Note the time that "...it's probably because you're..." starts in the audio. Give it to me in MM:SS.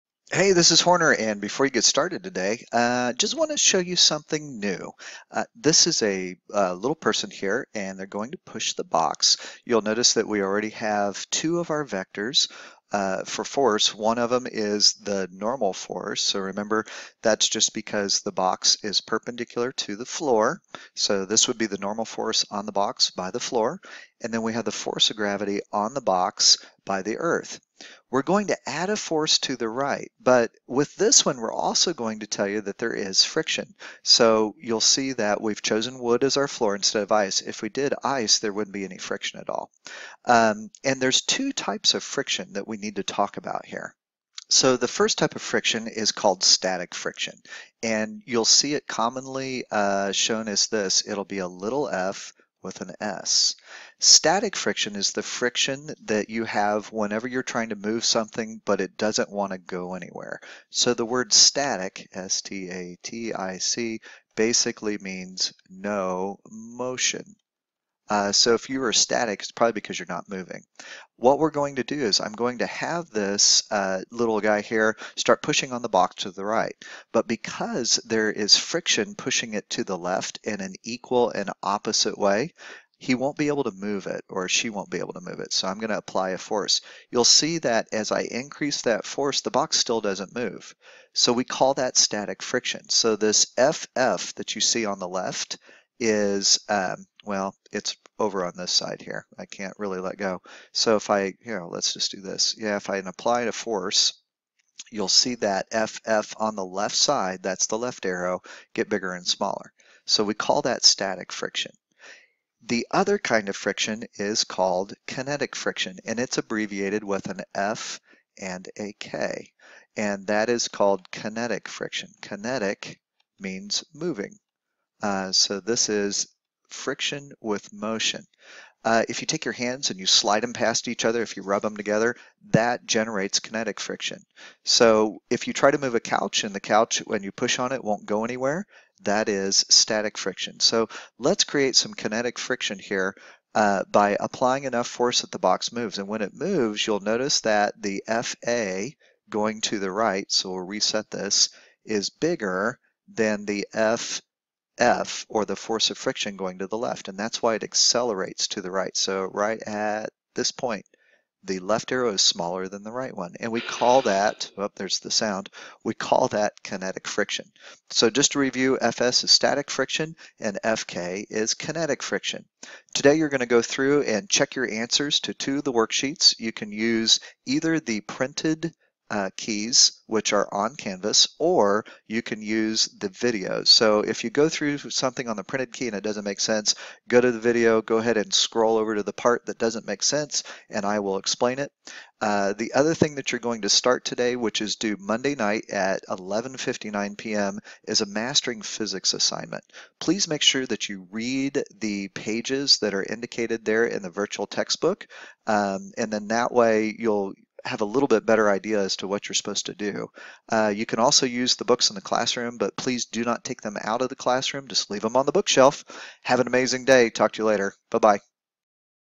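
01:09.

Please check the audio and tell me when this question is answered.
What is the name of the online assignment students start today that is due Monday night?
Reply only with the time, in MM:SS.
03:18.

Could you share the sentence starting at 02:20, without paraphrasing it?
So let's create some kinetic friction here uh, by applying enough force that the box moves.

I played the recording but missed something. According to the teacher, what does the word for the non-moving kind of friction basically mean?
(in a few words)
no motion.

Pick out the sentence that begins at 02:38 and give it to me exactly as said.
So right at this point, the left arrow is smaller than the right one.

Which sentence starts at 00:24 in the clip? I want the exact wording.
And then we have the force of gravity on the box by the earth.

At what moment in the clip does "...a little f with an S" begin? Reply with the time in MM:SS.
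00:51.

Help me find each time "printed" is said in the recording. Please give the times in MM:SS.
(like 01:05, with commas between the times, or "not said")
02:58, 03:05.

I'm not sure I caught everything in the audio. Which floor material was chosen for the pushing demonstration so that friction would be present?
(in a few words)
wood.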